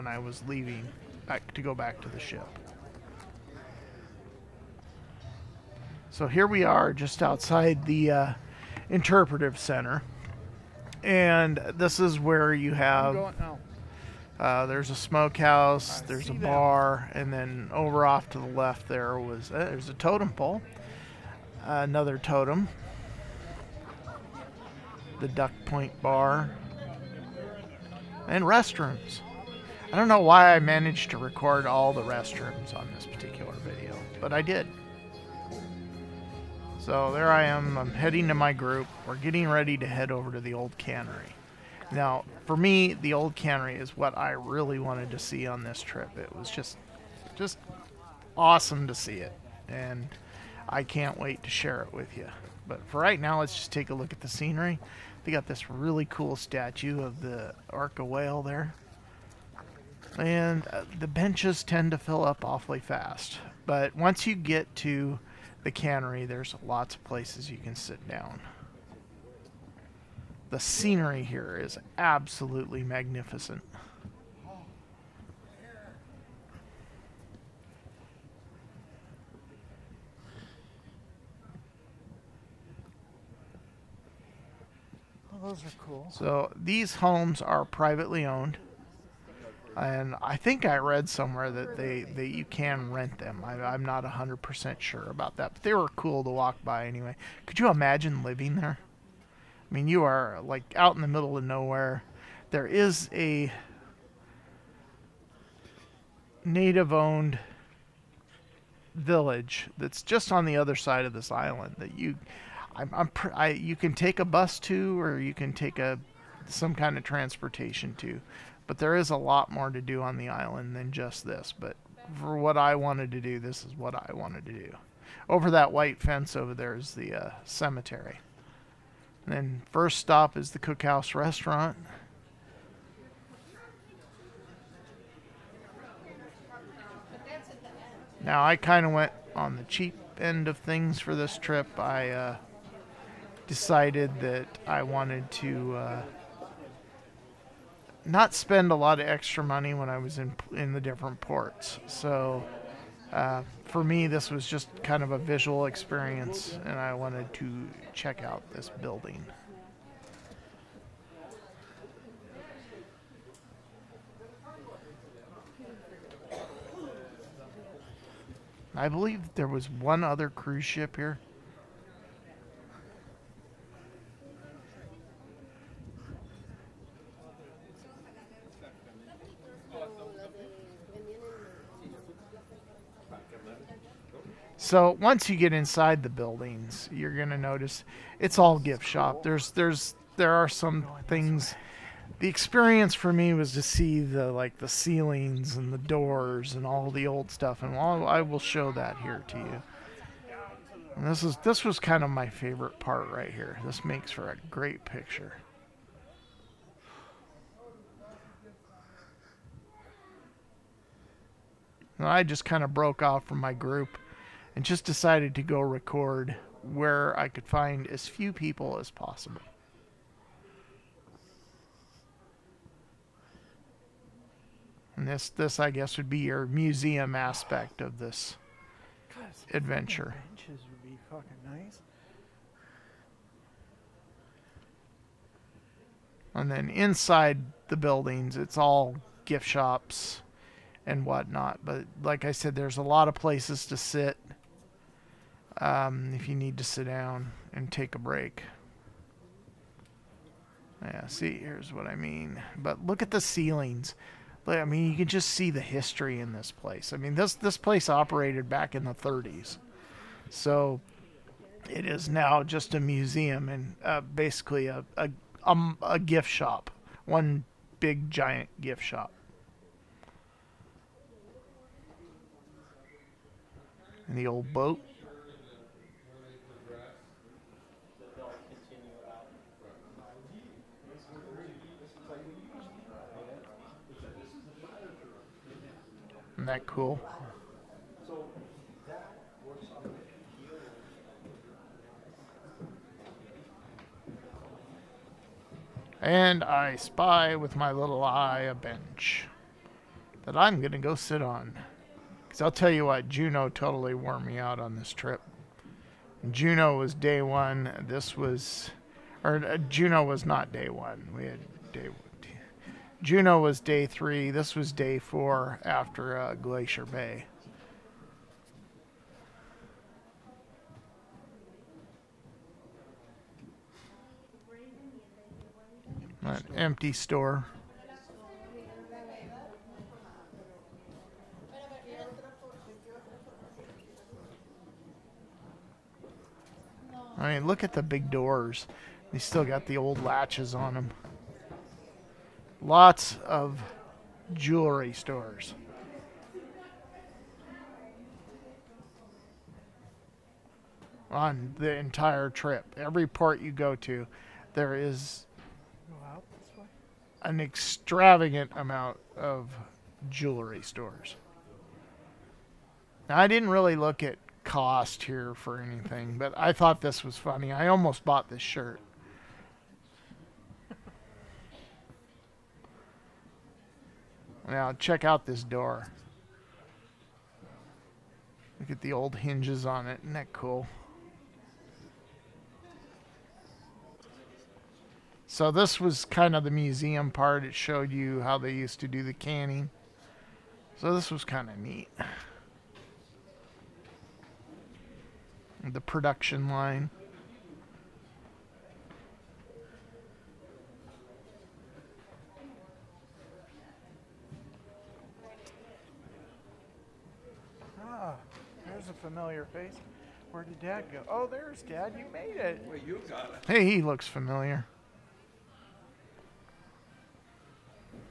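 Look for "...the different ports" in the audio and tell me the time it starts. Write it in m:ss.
2:30.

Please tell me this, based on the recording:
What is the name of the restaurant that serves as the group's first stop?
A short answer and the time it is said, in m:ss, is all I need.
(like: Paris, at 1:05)
Cookhouse restaurant, at 2:10.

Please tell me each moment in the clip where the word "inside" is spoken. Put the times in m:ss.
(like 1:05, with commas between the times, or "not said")
3:05, 3:56.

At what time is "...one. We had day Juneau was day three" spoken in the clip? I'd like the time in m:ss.
5:10.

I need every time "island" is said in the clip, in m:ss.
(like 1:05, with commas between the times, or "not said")
1:51, 2:00.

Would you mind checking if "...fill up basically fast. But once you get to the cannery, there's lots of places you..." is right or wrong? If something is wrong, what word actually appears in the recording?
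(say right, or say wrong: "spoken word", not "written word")
wrong: "awfully", not "basically".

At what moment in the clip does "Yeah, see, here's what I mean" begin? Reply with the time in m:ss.
4:10.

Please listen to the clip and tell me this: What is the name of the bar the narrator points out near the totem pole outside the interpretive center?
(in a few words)
Duck Point Bar.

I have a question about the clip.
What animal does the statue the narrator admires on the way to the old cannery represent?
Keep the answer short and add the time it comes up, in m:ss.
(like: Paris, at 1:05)
Orca whale, at 0:57.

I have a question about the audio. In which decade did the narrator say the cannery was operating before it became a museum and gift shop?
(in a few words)
1930s.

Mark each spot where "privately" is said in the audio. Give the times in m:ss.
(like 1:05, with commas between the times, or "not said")
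1:27.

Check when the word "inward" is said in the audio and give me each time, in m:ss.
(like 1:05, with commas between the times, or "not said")
not said.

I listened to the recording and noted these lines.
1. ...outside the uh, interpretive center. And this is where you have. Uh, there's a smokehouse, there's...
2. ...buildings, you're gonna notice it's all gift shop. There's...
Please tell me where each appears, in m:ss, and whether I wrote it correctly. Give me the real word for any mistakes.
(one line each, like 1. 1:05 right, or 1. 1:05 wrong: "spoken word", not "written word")
1. 0:07 right
2. 3:06 right.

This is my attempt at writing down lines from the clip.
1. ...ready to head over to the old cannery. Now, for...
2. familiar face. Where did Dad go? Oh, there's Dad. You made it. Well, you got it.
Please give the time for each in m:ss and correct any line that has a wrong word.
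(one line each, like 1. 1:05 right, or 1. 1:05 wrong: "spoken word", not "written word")
1. 0:39 right
2. 6:49 right.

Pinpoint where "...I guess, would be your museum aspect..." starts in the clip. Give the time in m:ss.
3:45.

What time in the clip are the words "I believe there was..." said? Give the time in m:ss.
2:48.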